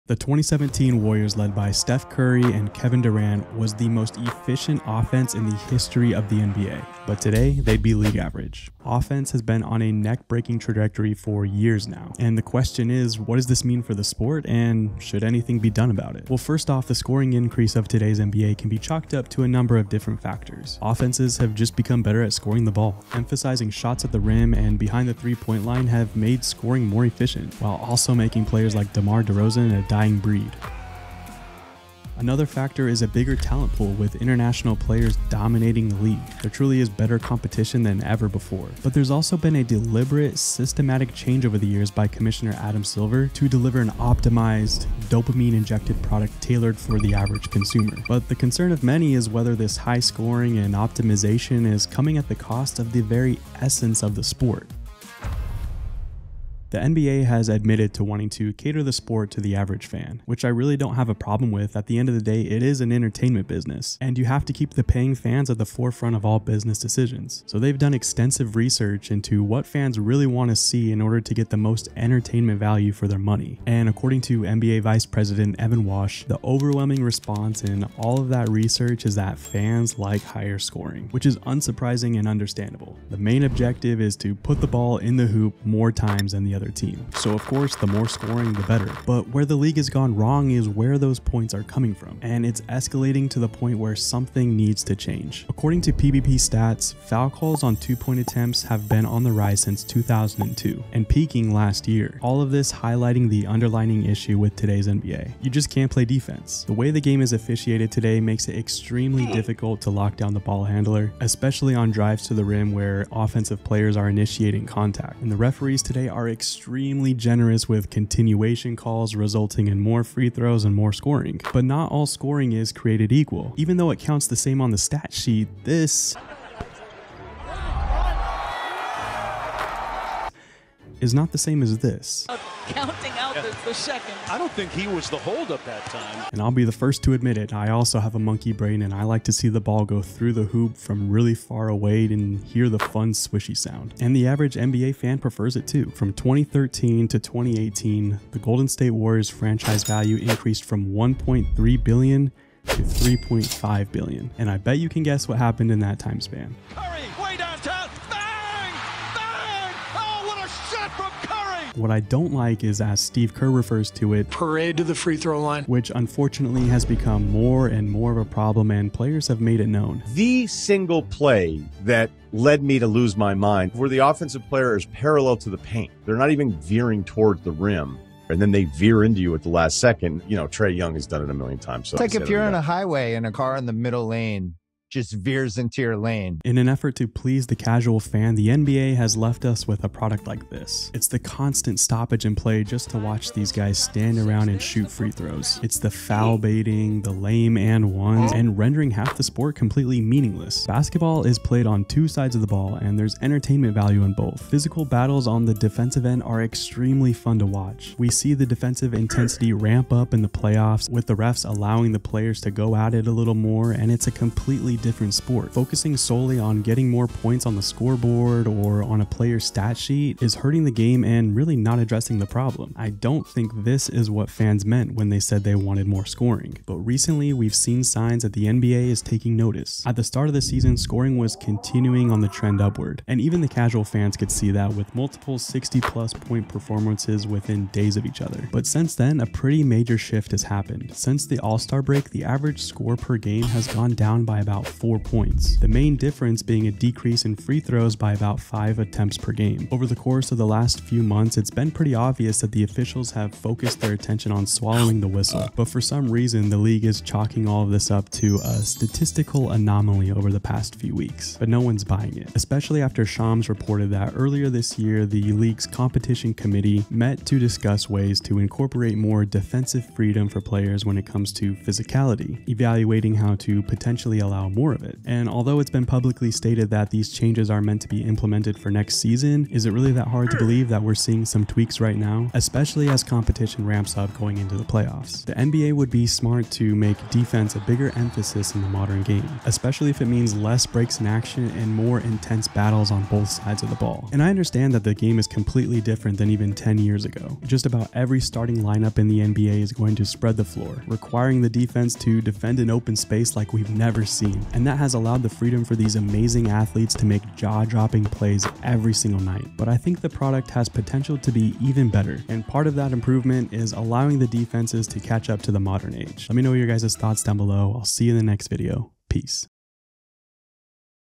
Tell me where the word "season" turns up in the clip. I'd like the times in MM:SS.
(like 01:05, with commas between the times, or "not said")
03:50, 04:38.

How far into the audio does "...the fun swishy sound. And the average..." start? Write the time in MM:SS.
02:22.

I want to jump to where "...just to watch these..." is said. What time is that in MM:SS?
03:12.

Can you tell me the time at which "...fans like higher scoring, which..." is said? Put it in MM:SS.
01:19.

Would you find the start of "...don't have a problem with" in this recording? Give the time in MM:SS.
01:00.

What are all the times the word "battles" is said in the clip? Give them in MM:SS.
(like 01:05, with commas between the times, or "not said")
03:24, 04:52.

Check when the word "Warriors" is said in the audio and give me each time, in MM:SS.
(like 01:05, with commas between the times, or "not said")
00:01, 02:28.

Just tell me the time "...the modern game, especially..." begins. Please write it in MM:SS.
04:48.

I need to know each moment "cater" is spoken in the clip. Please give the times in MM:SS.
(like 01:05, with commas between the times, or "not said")
00:58.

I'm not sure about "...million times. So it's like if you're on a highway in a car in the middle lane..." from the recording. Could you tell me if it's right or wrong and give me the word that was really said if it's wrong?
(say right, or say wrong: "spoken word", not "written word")
right.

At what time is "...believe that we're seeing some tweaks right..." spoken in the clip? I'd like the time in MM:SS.
04:40.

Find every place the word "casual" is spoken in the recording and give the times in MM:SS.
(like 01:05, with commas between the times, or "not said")
03:07, 03:53.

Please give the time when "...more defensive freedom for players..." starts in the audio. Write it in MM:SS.
04:28.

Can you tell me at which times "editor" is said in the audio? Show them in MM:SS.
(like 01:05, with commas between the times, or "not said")
not said.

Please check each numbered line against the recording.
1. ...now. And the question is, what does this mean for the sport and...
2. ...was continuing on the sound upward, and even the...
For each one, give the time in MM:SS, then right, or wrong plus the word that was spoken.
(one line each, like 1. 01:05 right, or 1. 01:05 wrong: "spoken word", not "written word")
1. 00:11 right
2. 03:51 wrong: "trend", not "sound".